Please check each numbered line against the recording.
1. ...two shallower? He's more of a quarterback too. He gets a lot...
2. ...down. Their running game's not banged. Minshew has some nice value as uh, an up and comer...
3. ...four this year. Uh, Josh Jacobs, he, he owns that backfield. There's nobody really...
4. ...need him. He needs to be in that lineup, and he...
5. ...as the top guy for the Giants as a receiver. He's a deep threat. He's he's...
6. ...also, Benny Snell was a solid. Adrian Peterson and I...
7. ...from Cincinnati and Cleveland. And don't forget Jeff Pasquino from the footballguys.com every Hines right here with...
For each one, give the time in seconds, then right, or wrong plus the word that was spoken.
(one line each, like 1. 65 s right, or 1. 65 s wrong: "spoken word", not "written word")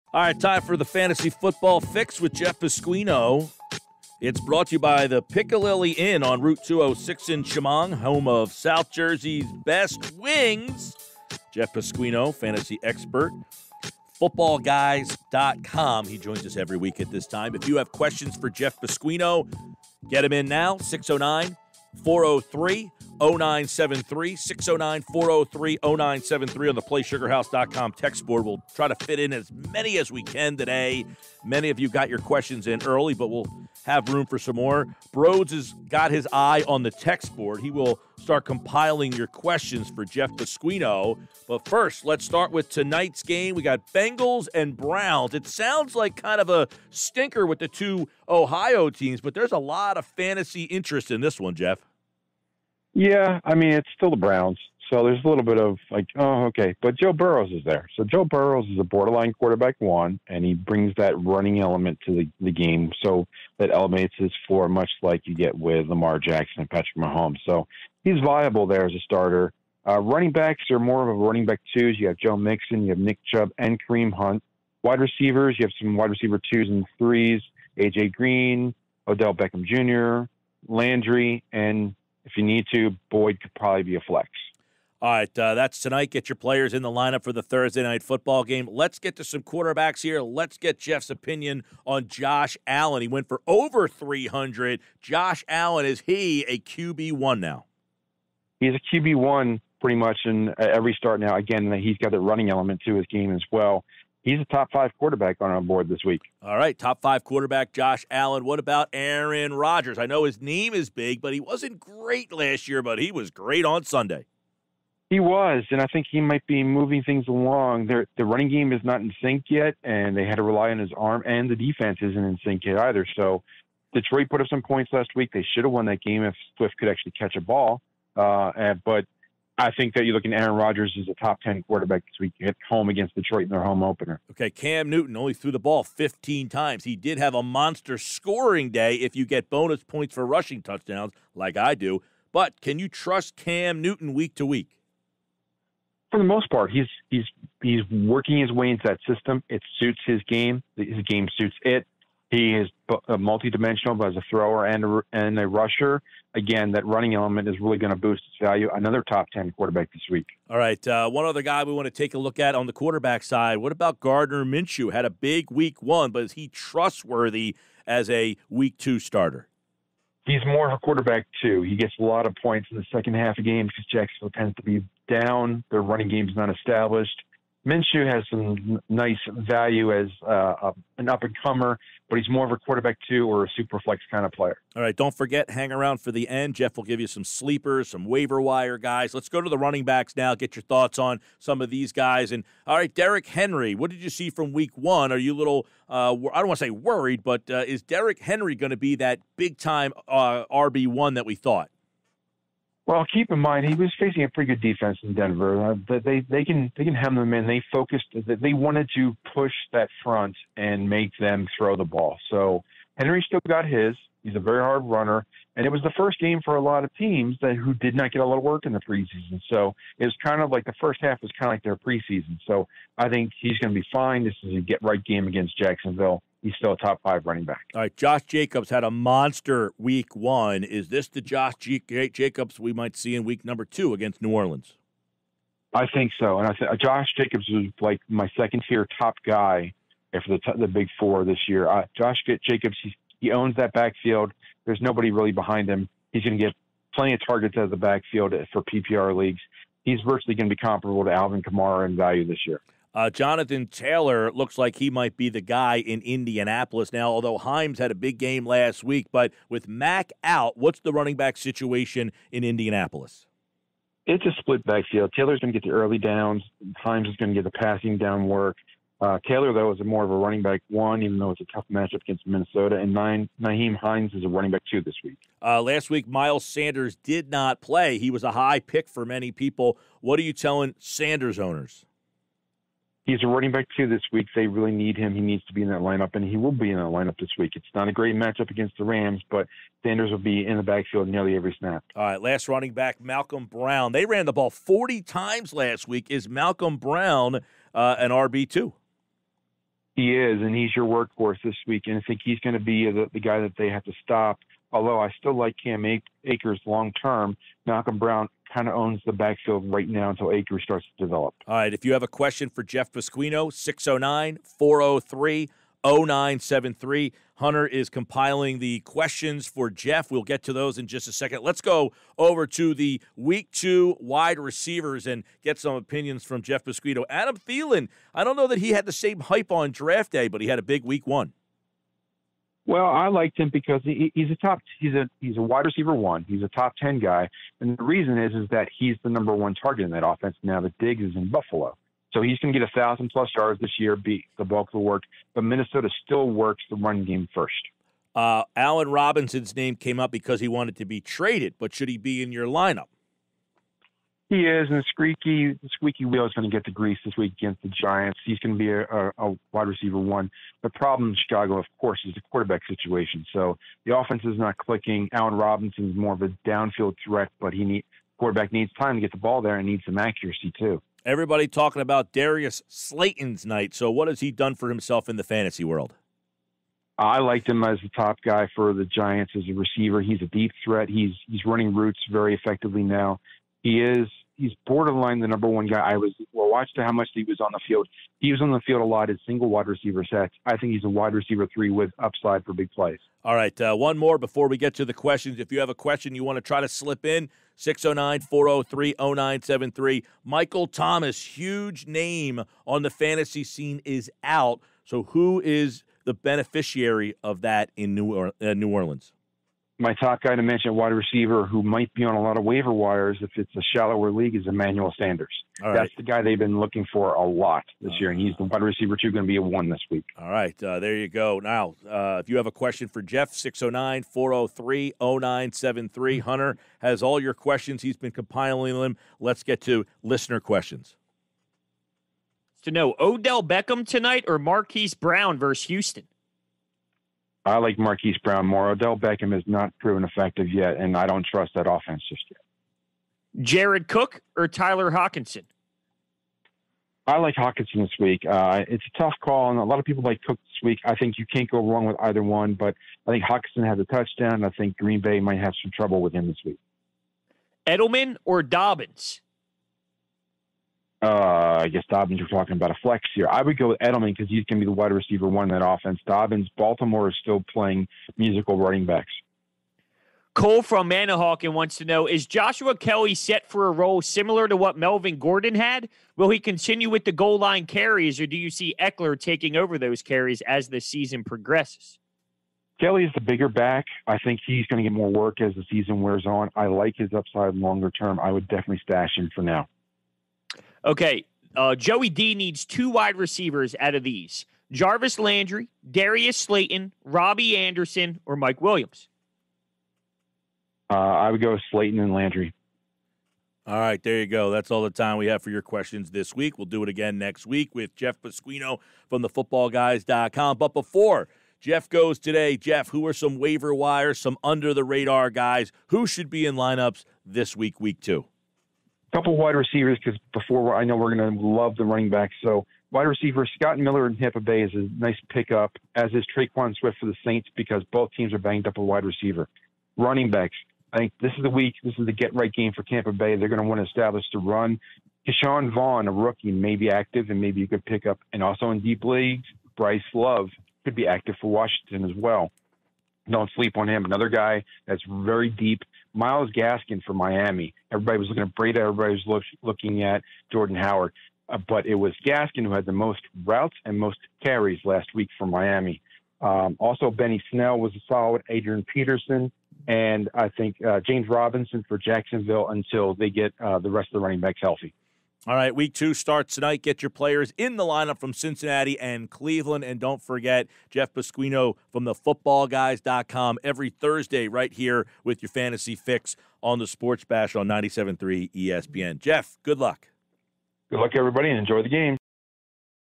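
1. 168 s wrong: "starter", not "shallower"
2. 175 s wrong: "established", not "banged"
3. 240 s right
4. 284 s right
5. 377 s right
6. 556 s right
7. 568 s wrong: "Thursday", not "Hines".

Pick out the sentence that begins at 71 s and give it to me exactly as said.
You have Joe Mixon, you have Nick Chubb, and Kareem Hunt.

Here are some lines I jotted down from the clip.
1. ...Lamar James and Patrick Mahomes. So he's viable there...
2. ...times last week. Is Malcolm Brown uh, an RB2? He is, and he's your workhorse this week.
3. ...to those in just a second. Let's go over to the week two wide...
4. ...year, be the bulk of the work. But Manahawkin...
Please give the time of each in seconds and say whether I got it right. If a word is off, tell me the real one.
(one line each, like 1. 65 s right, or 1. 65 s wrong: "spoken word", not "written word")
1. 65 s wrong: "Jackson", not "James"
2. 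295 s right
3. 320 s right
4. 343 s wrong: "Minnesota", not "Manahawkin".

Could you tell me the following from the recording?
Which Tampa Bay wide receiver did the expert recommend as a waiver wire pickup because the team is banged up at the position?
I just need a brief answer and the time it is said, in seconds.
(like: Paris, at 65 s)
Scott Miller, at 523 s.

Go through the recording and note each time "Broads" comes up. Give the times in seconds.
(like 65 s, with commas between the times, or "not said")
35 s.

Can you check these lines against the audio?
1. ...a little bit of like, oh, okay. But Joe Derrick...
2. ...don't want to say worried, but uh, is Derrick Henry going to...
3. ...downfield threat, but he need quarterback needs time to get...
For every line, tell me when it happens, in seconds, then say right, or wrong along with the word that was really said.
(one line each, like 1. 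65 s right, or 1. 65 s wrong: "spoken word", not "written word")
1. 55 s wrong: "Burrows", not "Derrick"
2. 196 s right
3. 366 s right.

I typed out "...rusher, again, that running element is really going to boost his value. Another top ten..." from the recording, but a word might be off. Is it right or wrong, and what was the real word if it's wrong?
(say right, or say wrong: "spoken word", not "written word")
right.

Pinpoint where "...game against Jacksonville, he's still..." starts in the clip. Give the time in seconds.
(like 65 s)
225 s.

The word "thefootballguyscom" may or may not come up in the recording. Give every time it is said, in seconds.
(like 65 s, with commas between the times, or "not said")
509 s.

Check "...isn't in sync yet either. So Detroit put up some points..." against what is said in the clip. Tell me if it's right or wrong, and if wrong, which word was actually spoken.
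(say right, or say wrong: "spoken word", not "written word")
right.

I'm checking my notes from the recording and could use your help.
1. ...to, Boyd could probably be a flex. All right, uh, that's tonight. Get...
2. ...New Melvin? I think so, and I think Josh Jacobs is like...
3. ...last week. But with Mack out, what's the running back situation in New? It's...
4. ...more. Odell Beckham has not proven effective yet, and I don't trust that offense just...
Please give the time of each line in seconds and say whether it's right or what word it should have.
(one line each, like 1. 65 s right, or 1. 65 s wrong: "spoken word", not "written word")
1. 82 s right
2. 234 s wrong: "Orleans", not "Melvin"
3. 258 s wrong: "Indianapolis", not "New"
4. 438 s right.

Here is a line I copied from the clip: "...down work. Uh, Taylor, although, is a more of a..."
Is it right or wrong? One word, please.
wrong.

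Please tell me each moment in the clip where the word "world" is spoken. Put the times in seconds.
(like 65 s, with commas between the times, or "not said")
375 s.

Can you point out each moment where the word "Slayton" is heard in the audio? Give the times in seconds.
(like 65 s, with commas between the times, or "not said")
372 s, 496 s, 501 s.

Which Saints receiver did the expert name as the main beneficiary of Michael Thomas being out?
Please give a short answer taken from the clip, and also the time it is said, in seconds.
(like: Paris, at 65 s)
Emmanuel Sanders, at 414 s.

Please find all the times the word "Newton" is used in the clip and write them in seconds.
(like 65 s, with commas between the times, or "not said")
134 s, 143 s.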